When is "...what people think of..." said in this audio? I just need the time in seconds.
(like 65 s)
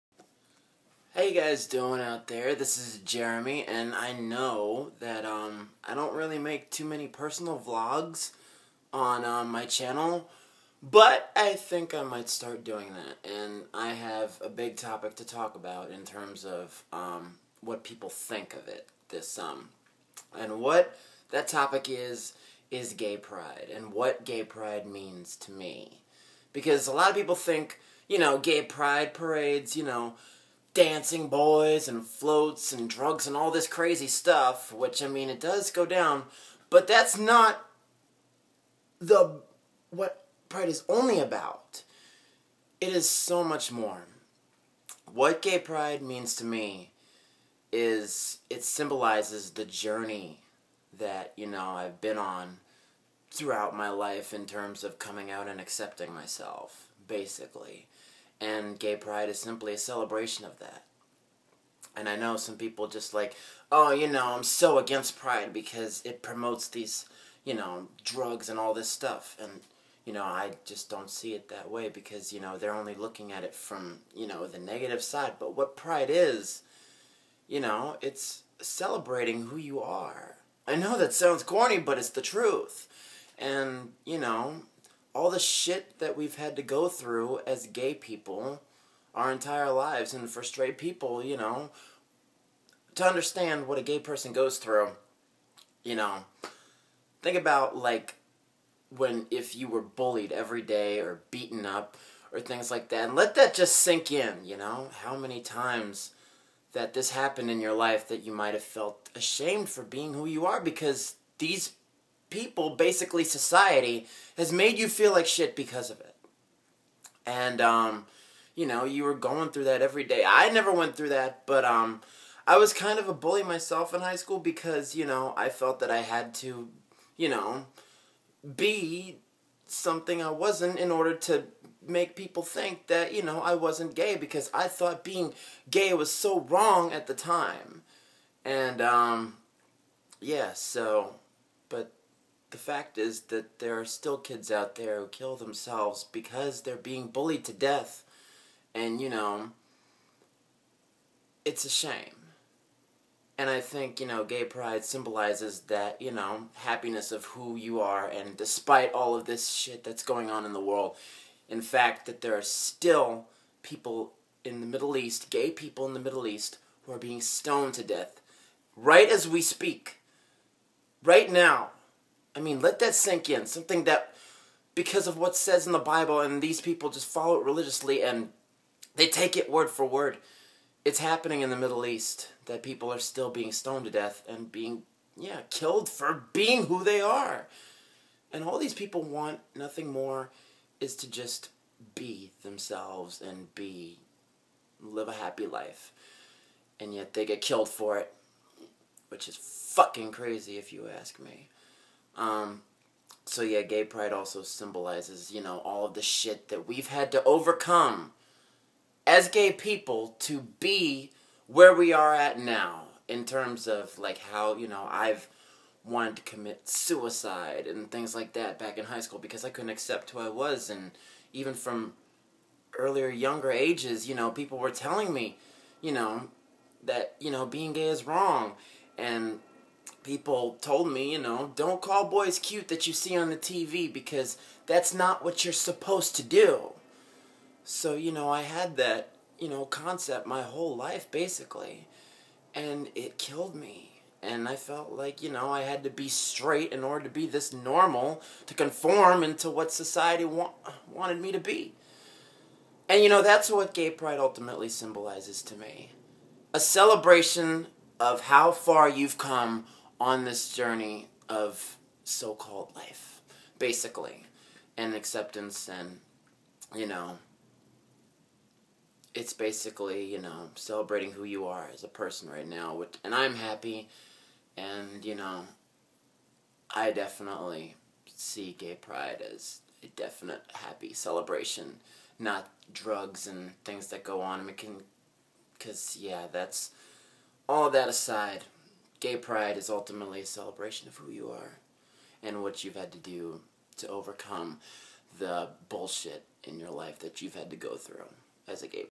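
17 s.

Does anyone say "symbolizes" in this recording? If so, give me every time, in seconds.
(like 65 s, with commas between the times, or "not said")
48 s, 154 s, 204 s, 254 s.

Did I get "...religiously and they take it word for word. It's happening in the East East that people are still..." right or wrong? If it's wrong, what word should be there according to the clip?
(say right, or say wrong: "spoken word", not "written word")
wrong: "Middle", not "East".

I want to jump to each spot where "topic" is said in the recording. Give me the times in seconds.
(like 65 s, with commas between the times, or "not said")
14 s, 21 s.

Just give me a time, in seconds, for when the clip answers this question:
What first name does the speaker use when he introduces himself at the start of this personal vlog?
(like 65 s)
3 s.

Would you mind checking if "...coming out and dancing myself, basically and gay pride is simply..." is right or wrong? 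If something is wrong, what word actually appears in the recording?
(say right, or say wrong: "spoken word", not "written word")
wrong: "accepting", not "dancing".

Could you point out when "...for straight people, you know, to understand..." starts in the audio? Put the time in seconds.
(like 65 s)
90 s.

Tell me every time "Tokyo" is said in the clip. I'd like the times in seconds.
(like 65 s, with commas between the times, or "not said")
not said.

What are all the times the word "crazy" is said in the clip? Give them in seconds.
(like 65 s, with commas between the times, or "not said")
33 s, 200 s.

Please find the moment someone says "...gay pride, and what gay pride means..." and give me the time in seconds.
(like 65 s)
22 s.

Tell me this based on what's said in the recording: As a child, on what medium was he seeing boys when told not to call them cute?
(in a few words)
TV.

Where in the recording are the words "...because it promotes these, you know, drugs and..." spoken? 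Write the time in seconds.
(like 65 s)
65 s.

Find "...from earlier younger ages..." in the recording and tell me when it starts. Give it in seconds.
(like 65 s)
221 s.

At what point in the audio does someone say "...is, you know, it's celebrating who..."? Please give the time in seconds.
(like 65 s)
76 s.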